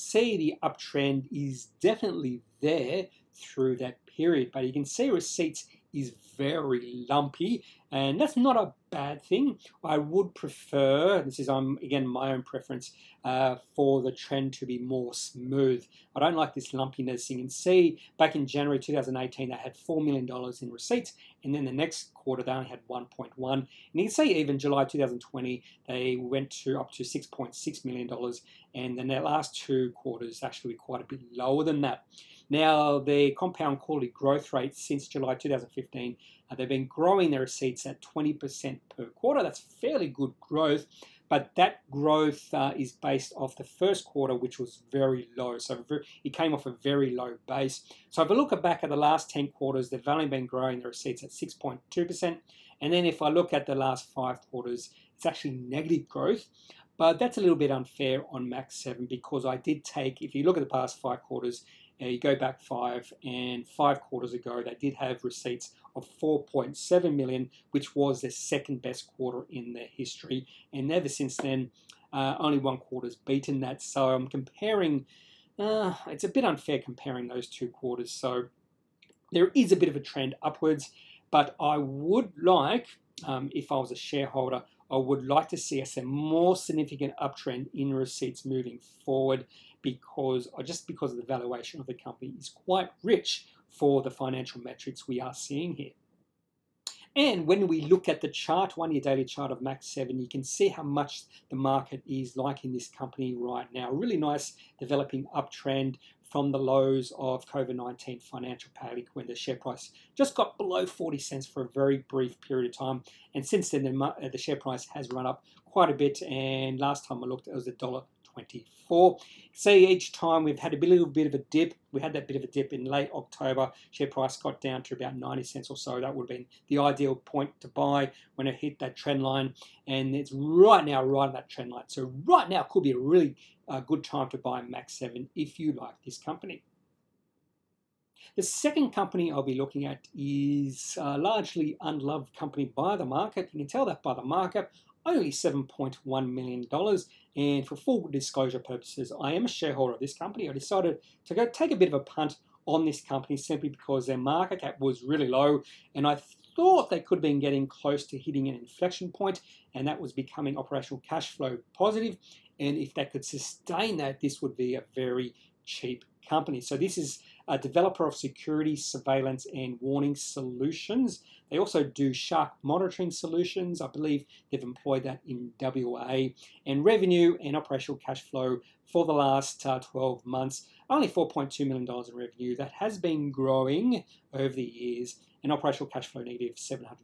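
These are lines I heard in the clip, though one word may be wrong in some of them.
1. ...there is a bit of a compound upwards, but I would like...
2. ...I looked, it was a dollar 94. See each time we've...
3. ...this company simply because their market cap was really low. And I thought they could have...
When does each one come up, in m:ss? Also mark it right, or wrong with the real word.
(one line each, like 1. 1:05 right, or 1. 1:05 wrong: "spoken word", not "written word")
1. 1:19 wrong: "trend", not "compound"
2. 1:57 wrong: "24", not "94"
3. 2:32 right.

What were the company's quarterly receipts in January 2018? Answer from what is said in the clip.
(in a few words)
$4 million.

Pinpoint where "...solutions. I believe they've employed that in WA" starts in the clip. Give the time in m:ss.
2:53.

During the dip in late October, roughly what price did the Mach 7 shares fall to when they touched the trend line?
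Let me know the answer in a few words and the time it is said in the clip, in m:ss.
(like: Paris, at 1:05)
90 cents, at 2:05.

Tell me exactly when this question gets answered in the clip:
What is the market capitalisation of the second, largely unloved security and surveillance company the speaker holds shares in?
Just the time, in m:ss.
2:25.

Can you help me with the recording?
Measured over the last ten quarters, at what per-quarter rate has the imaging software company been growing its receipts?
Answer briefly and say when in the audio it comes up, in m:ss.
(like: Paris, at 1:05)
6.2%, at 0:51.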